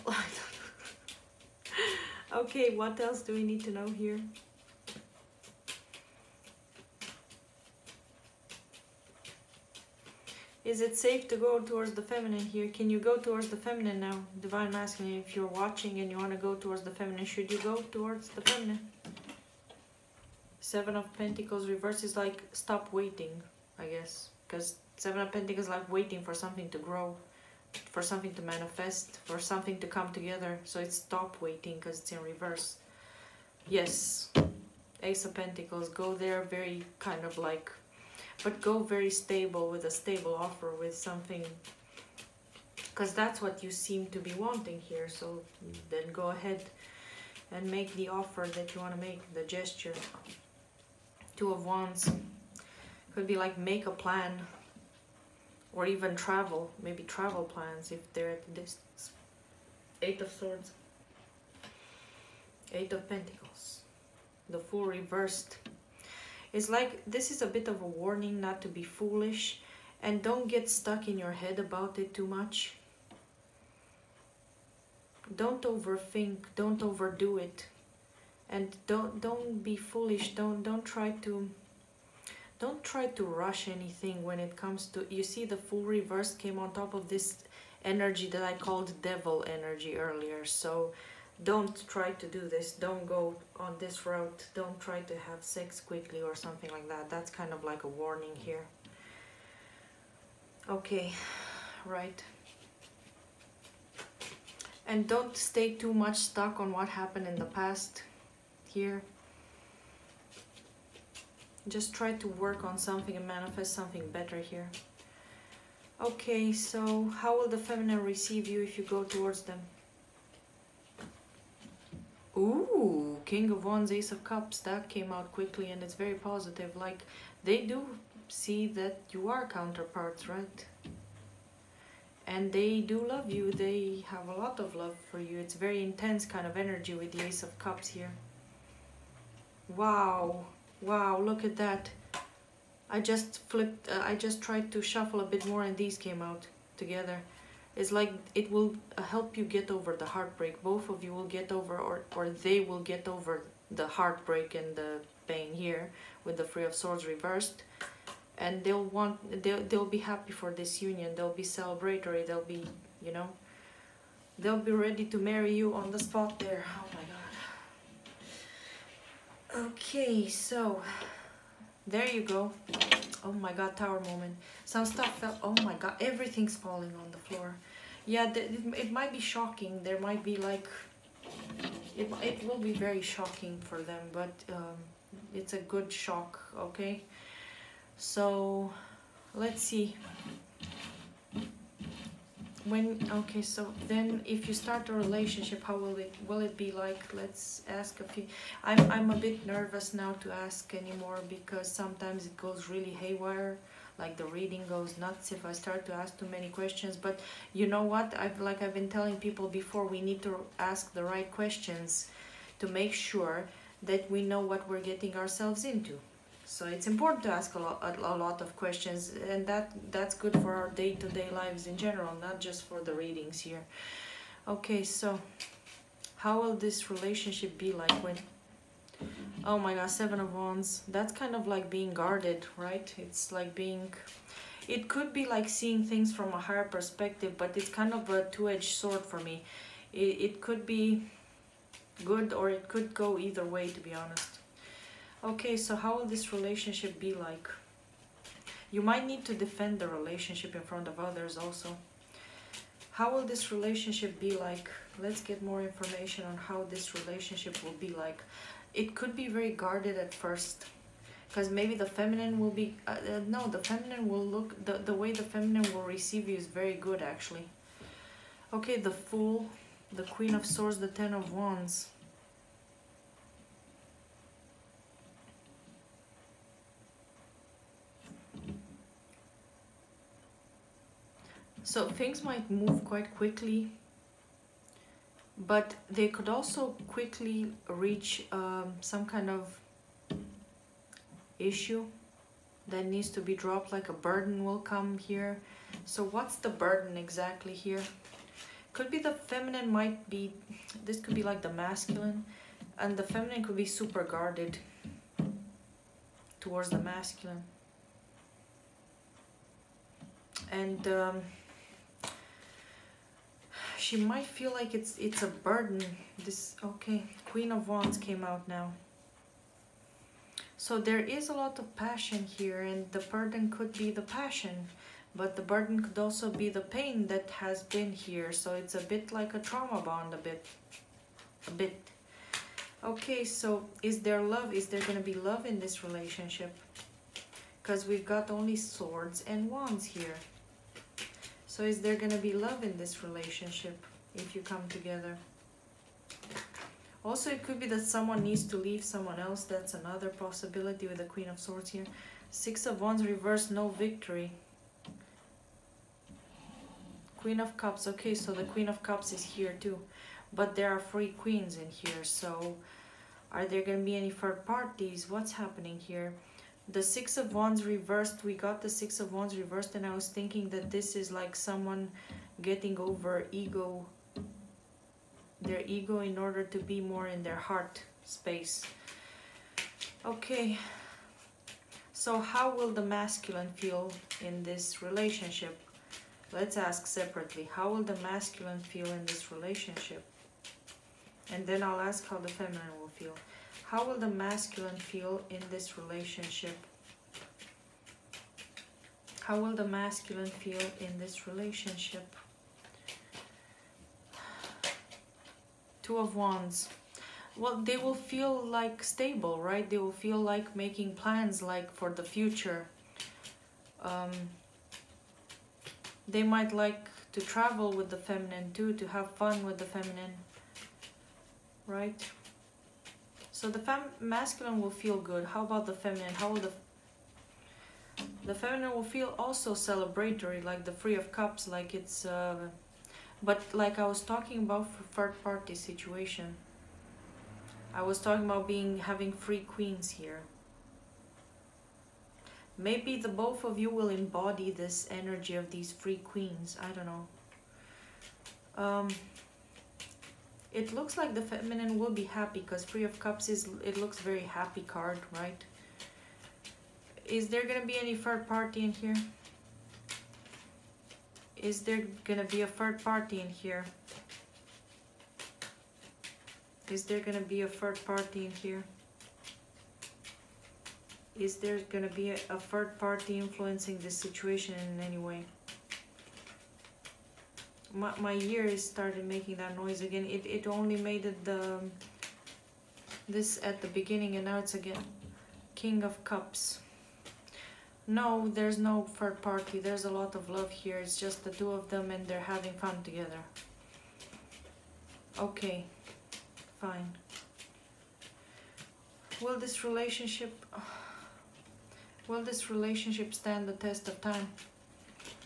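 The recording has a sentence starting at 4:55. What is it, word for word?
So what's the burden exactly here?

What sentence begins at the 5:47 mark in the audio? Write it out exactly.
Also, it could be that someone needs to leave someone else.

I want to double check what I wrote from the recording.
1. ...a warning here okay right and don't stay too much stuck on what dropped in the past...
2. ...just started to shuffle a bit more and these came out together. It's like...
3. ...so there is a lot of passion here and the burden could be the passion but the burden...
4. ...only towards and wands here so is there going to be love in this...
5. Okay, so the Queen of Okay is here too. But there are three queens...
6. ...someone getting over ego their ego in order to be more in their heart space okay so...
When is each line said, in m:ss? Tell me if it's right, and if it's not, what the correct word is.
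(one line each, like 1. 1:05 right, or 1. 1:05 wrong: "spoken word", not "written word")
1. 1:37 wrong: "happened", not "dropped"
2. 2:24 wrong: "tried", not "started"
3. 5:20 right
4. 5:38 wrong: "swords", not "towards"
5. 5:57 wrong: "Cups", not "Okay"
6. 6:11 right.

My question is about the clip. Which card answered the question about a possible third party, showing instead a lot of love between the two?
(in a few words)
King of Cups.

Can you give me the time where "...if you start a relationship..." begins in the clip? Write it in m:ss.
3:14.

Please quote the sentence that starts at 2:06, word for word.
Like, they do see that you are counterparts, right?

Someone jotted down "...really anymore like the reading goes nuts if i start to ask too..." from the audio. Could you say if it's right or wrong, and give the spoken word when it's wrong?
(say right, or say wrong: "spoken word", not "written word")
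wrong: "haywire", not "anymore".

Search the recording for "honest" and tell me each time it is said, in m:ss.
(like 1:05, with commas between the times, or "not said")
4:04.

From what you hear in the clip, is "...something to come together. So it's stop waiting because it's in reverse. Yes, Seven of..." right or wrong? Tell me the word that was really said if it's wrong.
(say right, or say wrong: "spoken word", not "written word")
wrong: "Ace", not "Seven".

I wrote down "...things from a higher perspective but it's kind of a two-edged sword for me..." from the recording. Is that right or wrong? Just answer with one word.
right.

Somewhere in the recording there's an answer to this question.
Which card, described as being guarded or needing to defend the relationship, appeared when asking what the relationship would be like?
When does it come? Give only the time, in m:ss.
3:49.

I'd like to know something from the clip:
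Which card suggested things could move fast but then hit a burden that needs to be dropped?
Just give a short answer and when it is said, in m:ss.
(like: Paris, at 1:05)
Ten of Wands, at 4:30.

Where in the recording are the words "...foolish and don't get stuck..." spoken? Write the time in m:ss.
1:08.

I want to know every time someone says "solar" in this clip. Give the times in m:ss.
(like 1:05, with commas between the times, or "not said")
not said.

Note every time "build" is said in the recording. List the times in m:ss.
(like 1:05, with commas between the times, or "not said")
not said.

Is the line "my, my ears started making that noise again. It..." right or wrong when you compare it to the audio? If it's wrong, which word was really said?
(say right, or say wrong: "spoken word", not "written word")
right.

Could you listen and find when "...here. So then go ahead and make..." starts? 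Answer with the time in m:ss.
0:44.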